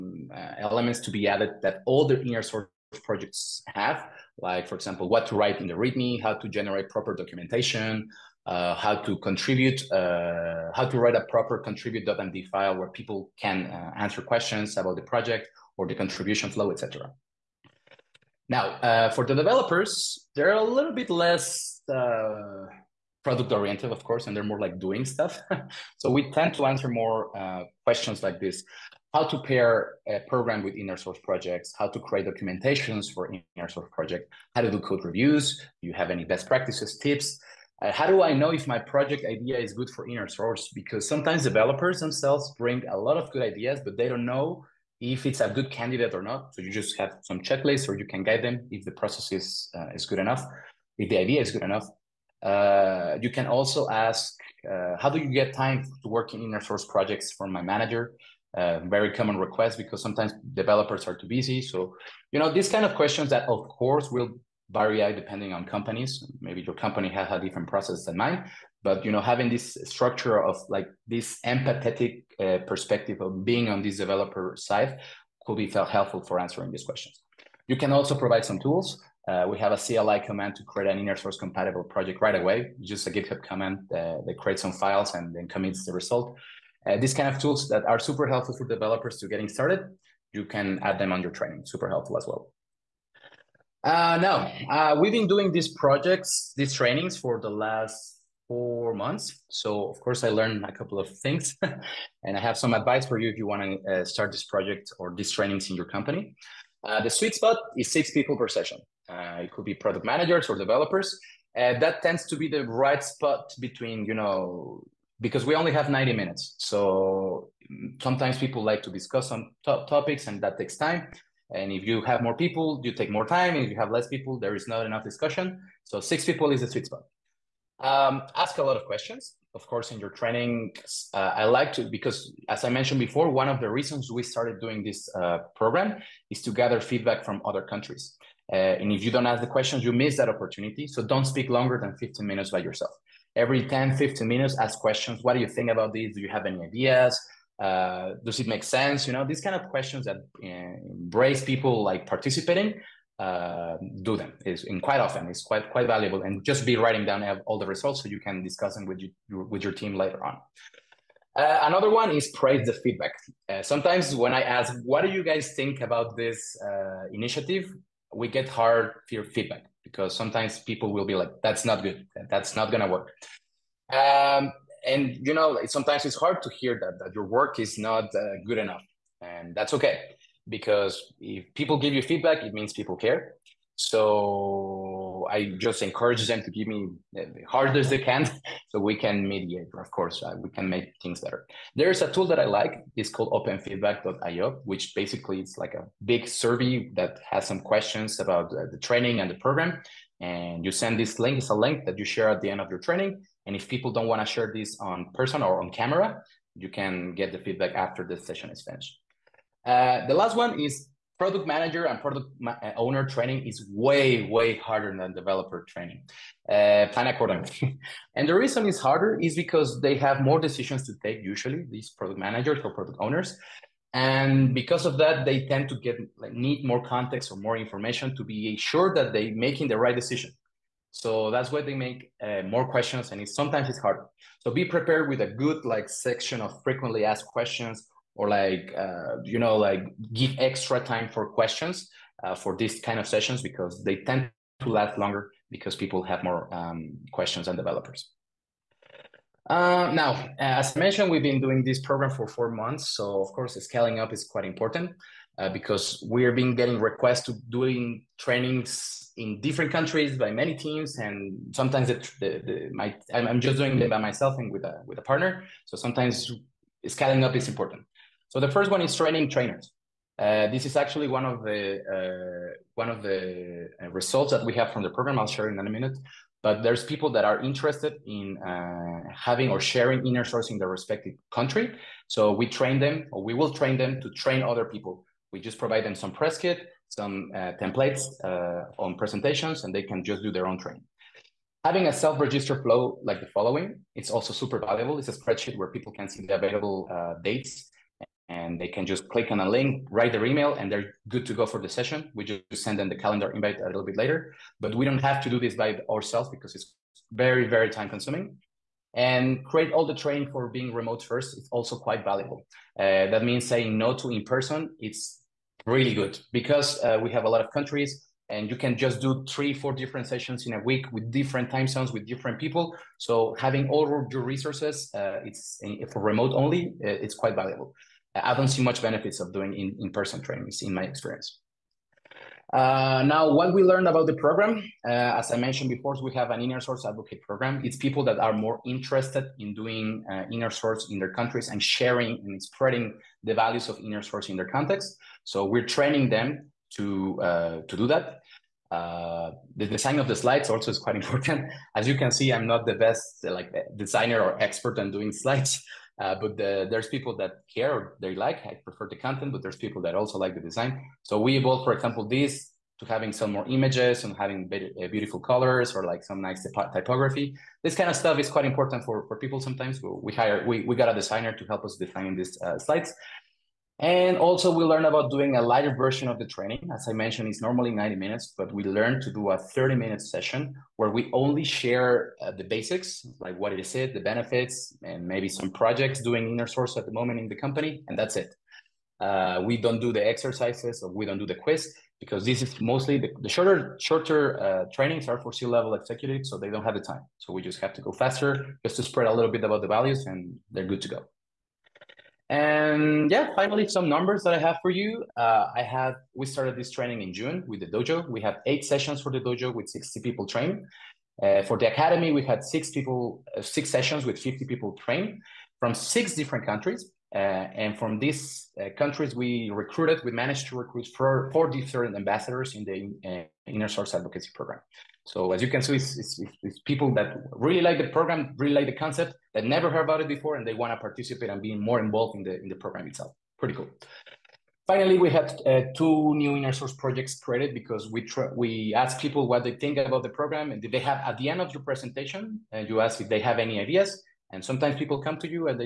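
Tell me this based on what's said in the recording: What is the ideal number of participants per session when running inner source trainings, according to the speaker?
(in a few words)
6.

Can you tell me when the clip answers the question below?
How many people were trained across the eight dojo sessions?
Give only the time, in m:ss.
6:49.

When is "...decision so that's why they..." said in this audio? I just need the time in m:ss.
3:50.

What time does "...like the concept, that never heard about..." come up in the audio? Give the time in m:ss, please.
7:08.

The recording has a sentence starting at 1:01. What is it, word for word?
So, you know, these kind of questions that, of course, will vary depending on companies.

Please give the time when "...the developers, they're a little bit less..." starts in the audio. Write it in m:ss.
0:19.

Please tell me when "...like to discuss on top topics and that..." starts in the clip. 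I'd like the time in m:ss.
1:58.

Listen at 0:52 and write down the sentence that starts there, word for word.
Uh, you can also ask, uh, how do you get time to work in inner source projects from my manager?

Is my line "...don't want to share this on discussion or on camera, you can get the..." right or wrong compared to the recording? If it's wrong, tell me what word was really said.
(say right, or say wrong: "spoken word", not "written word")
wrong: "person", not "discussion".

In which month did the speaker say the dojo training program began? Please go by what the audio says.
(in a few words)
June.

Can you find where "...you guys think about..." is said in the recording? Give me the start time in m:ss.
2:45.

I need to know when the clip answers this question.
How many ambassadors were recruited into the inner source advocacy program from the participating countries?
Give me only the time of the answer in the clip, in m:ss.
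7:01.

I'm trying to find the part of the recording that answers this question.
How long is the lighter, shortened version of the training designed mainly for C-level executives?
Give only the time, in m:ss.
6:19.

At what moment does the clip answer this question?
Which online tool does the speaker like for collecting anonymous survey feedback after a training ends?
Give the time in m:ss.
3:13.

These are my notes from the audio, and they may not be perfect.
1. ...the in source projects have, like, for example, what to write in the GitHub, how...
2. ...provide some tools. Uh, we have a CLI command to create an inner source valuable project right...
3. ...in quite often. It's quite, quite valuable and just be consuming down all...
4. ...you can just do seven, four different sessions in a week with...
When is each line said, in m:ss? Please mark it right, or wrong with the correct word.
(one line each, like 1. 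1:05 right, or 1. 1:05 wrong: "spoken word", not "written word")
1. 0:02 wrong: "README", not "GitHub"
2. 1:18 wrong: "compatible", not "valuable"
3. 2:34 wrong: "writing", not "consuming"
4. 5:18 wrong: "three", not "seven".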